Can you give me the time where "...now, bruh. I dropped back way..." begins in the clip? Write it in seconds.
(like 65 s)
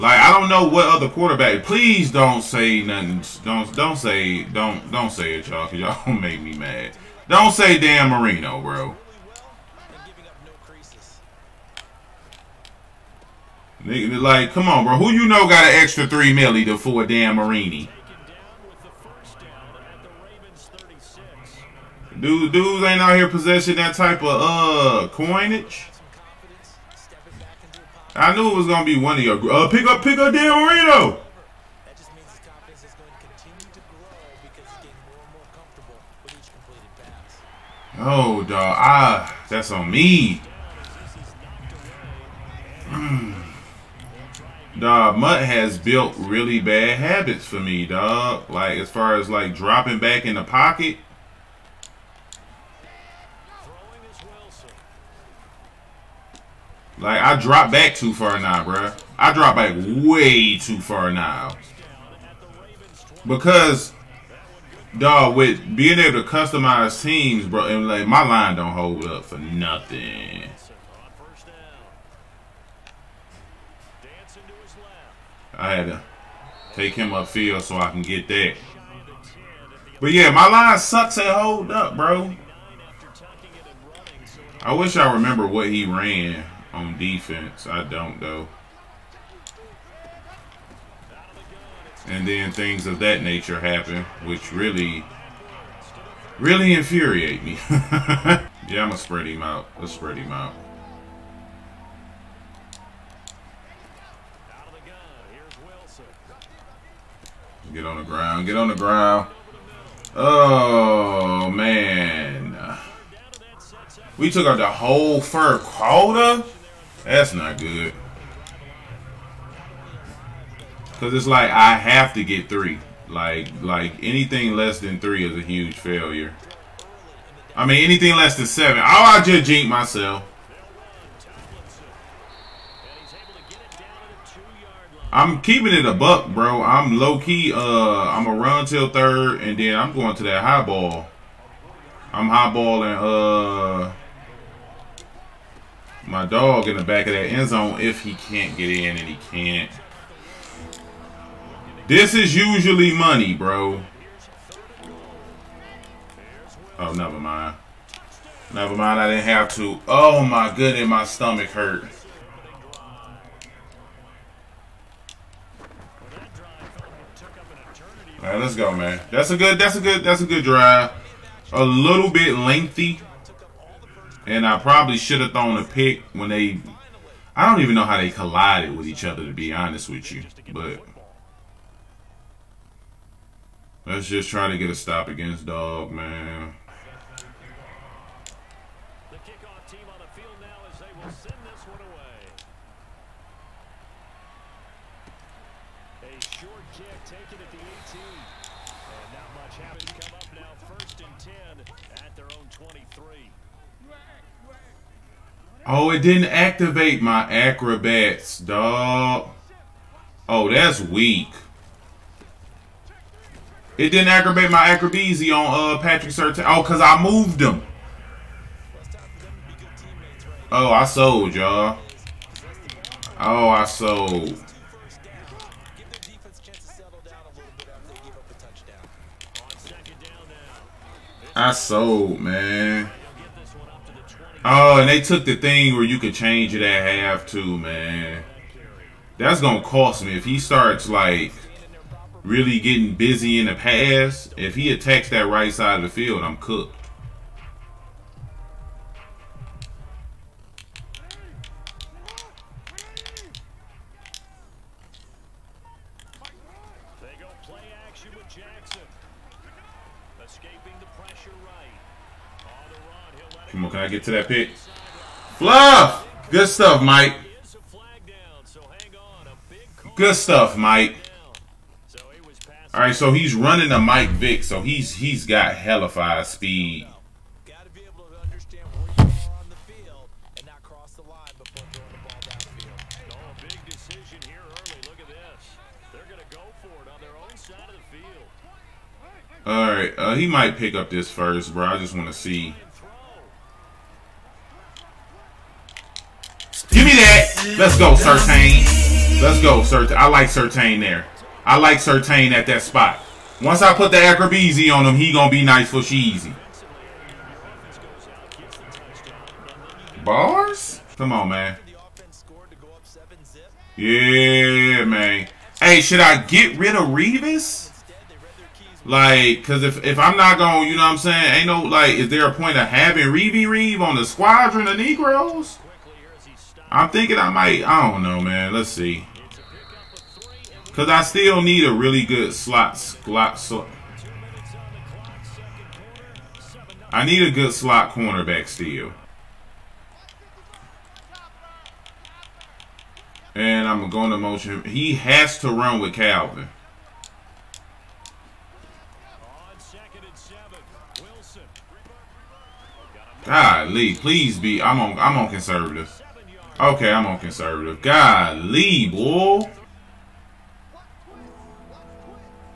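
58 s.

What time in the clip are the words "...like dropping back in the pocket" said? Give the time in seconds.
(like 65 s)
49 s.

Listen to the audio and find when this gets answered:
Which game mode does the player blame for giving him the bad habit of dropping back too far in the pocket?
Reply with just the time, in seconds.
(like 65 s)
45 s.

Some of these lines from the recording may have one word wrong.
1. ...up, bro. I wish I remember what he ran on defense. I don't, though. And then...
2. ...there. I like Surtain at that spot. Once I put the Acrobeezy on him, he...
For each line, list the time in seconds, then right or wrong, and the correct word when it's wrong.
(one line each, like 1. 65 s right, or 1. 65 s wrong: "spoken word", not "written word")
1. 81 s right
2. 300 s right.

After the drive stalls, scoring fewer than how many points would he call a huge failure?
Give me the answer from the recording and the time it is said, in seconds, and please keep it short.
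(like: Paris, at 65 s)
7, at 128 s.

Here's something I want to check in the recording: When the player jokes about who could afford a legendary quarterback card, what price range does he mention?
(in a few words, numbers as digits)
3 to 4 million.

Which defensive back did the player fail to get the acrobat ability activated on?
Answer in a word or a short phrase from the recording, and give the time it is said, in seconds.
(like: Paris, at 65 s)
Patrick Surtain, at 215 s.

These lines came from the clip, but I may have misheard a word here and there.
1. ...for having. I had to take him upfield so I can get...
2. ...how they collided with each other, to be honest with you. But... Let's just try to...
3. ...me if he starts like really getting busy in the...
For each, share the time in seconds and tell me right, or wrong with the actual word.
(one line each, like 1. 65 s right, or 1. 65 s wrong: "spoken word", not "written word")
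1. 69 s wrong: "nothing", not "having"
2. 177 s right
3. 240 s right.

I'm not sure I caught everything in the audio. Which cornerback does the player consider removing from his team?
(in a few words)
Revis.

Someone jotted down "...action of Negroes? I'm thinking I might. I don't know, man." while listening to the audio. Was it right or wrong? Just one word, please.
wrong.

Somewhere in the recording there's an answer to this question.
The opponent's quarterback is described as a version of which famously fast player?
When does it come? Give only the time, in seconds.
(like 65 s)
273 s.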